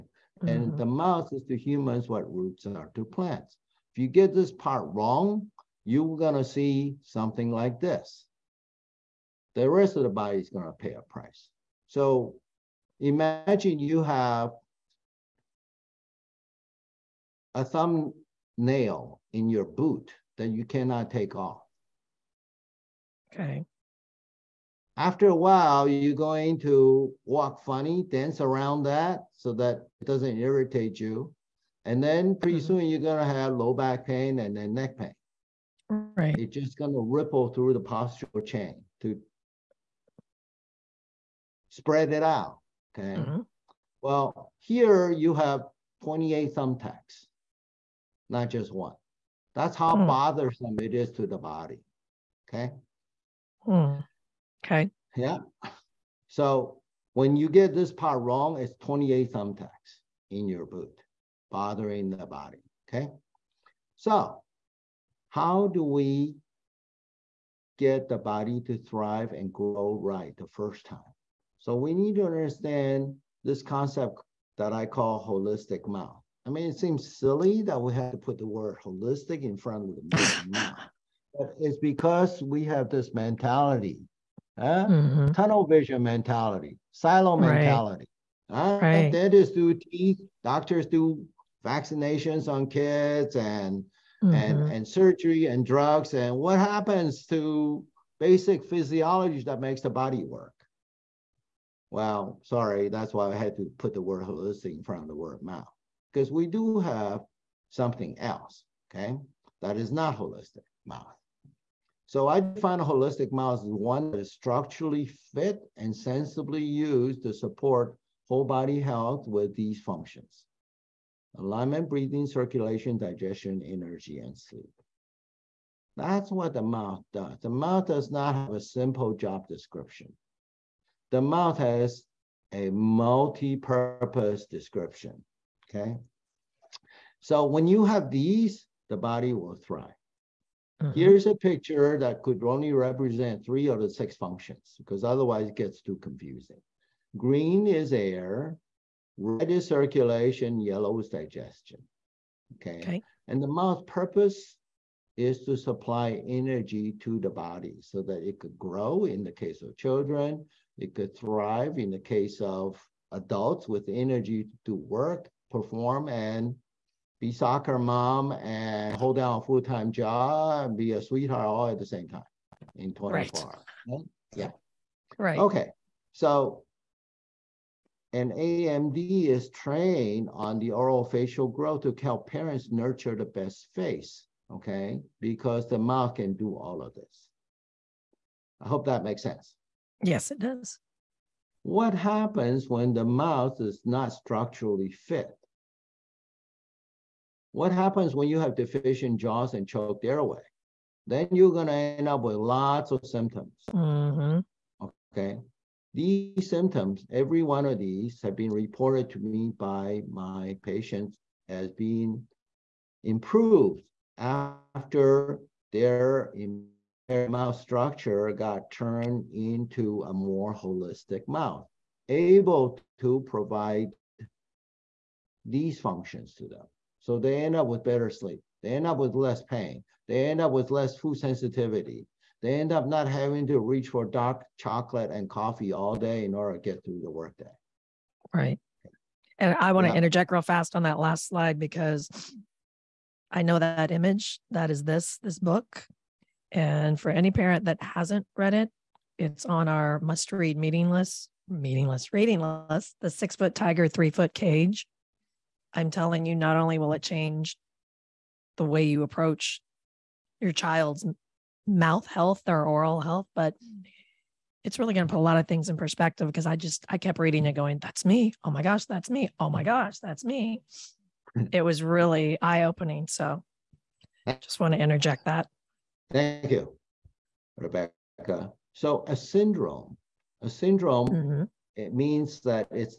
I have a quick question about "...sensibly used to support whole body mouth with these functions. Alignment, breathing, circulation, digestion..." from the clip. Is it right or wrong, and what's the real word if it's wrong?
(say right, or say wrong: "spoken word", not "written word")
wrong: "health", not "mouth".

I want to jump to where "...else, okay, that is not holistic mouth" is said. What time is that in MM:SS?
01:48.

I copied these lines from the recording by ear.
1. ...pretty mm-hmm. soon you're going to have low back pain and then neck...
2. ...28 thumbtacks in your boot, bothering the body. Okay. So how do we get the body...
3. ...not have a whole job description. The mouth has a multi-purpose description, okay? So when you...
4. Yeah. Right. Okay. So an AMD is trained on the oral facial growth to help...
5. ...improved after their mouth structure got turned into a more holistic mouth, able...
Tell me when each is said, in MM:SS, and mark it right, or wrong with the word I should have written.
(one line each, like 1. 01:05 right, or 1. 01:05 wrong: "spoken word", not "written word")
1. 00:32 right
2. 00:58 right
3. 02:08 wrong: "simple", not "whole"
4. 02:54 right
5. 03:33 right.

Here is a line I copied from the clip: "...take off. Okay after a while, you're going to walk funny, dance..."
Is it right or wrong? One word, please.
right.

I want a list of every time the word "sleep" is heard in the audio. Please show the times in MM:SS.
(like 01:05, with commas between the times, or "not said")
02:04, 03:48.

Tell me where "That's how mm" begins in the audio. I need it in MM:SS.
00:49.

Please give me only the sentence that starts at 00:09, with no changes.
The rest of the body is going to pay a price.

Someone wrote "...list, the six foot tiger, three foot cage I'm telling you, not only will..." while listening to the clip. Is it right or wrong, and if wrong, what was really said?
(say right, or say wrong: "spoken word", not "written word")
right.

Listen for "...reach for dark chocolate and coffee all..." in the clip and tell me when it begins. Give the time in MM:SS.
03:53.